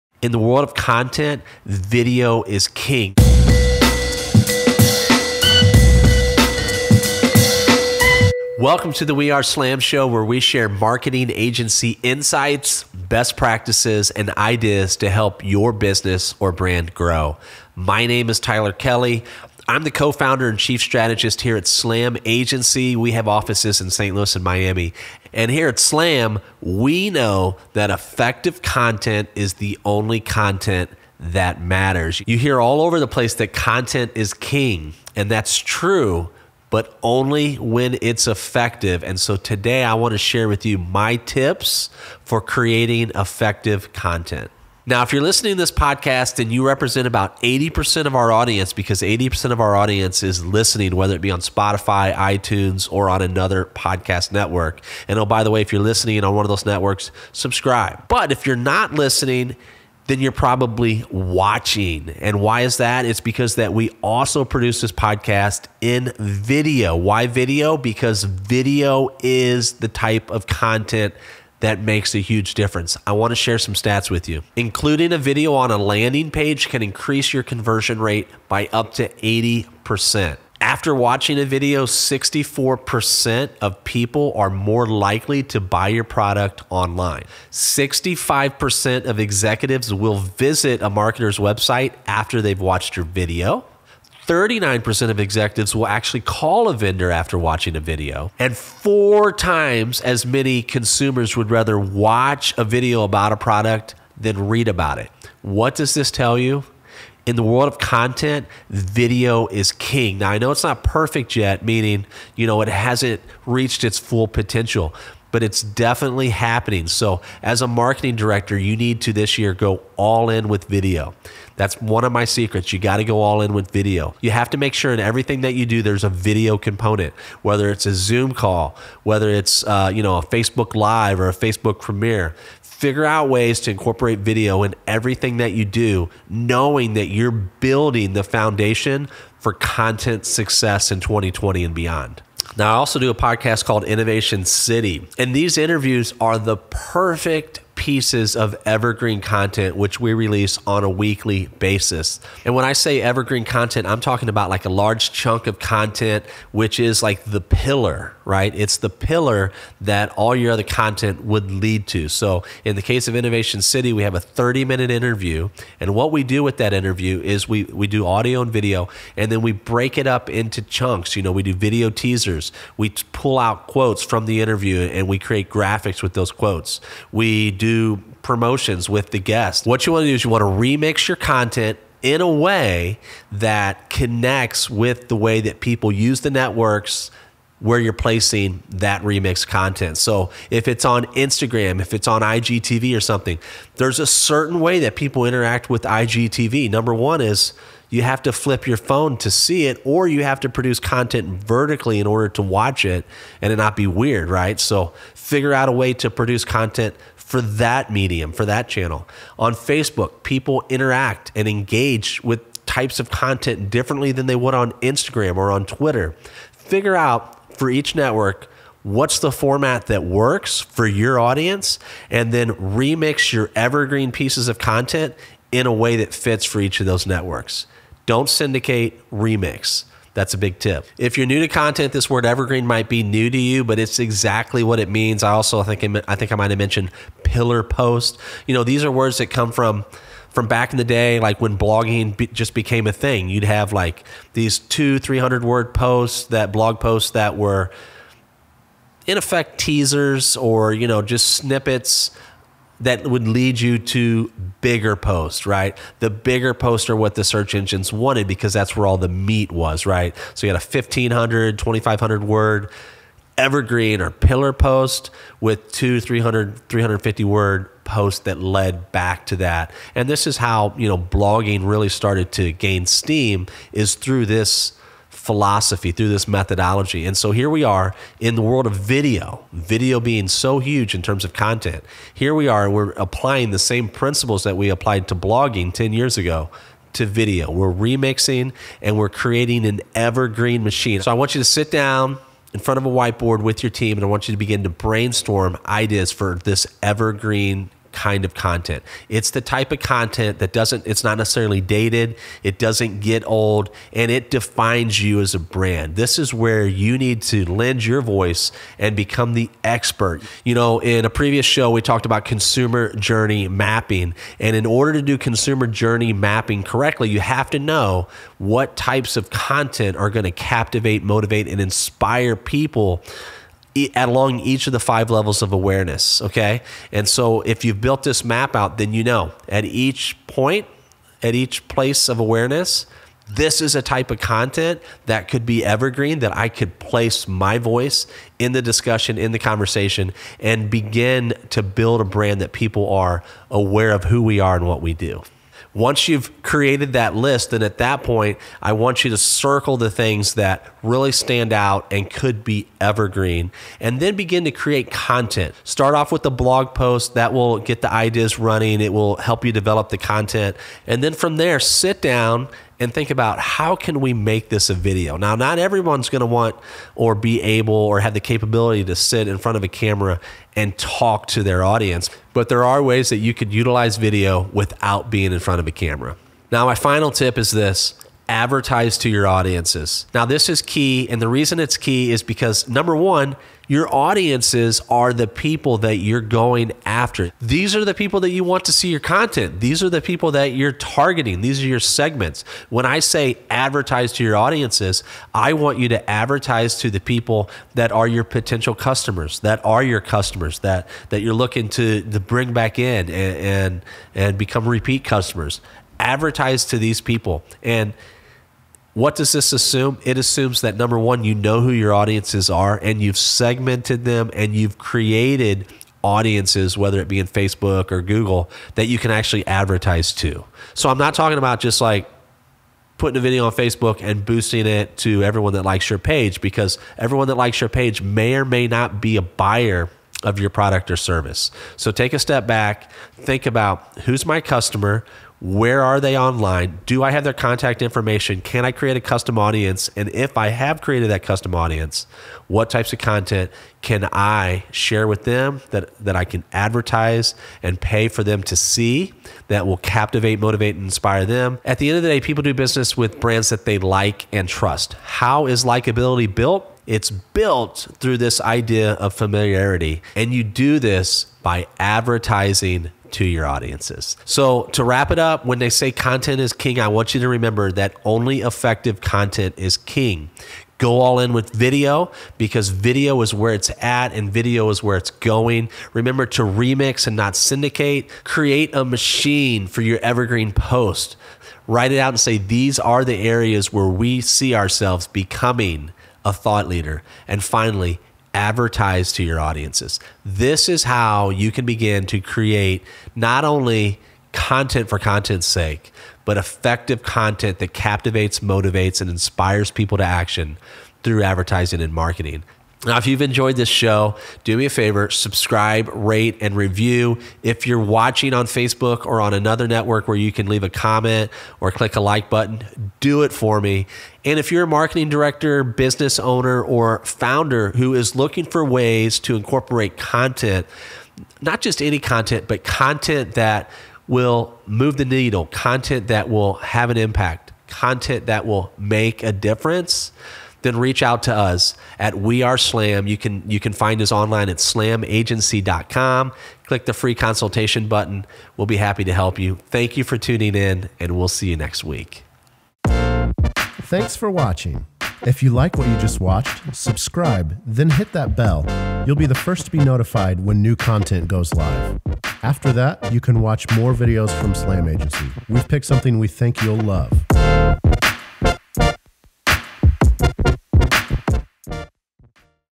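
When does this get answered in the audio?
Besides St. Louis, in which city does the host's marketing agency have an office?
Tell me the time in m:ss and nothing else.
0:24.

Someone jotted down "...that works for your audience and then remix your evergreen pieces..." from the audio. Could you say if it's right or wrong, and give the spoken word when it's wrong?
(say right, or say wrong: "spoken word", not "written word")
right.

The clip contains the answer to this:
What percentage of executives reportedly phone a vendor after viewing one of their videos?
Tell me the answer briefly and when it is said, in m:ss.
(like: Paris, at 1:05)
39%, at 1:34.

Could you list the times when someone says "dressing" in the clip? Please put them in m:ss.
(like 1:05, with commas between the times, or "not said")
not said.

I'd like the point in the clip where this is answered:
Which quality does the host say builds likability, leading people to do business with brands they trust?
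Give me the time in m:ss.
7:39.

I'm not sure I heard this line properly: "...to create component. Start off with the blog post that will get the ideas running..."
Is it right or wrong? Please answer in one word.
wrong.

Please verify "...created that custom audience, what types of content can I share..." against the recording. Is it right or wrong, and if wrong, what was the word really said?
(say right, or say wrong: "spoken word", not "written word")
right.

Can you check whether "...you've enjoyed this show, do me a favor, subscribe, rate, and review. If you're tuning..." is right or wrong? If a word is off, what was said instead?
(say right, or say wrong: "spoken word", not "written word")
wrong: "watching", not "tuning".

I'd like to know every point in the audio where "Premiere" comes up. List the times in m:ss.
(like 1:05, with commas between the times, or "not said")
2:11.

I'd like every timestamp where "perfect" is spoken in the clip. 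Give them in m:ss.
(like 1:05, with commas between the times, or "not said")
1:50, 2:26.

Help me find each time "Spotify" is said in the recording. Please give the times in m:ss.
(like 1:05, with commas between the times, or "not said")
0:51.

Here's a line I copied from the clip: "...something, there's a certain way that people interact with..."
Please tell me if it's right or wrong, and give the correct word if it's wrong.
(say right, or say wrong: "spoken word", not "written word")
right.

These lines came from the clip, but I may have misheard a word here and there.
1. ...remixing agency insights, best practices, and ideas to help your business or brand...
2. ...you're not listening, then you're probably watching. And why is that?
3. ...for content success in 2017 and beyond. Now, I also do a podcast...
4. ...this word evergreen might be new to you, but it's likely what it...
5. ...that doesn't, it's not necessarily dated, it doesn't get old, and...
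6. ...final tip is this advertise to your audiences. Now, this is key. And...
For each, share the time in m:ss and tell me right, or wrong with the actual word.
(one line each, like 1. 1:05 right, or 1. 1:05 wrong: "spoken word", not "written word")
1. 0:10 wrong: "marketing", not "remixing"
2. 0:58 right
3. 2:19 wrong: "2020", not "2017"
4. 3:51 wrong: "exactly", not "likely"
5. 5:00 right
6. 6:16 right.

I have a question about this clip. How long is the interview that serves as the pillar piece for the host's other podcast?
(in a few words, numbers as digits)
30 minutes.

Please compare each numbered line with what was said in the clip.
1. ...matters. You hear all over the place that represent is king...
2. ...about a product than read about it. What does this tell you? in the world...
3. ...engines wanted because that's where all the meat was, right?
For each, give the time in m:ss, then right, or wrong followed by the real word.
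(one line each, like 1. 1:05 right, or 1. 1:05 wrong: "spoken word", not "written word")
1. 0:31 wrong: "content", not "represent"
2. 1:43 right
3. 4:17 right.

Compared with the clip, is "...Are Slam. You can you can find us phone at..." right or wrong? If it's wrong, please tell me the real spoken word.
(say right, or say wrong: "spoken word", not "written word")
wrong: "online", not "phone".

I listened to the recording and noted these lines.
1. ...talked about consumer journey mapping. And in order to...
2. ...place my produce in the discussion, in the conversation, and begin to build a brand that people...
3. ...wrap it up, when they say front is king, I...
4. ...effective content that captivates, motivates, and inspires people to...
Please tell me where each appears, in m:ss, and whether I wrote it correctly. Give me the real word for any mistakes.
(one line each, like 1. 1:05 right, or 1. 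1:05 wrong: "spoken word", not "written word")
1. 5:11 right
2. 5:36 wrong: "voice", not "produce"
3. 7:44 wrong: "content", not "front"
4. 8:16 right.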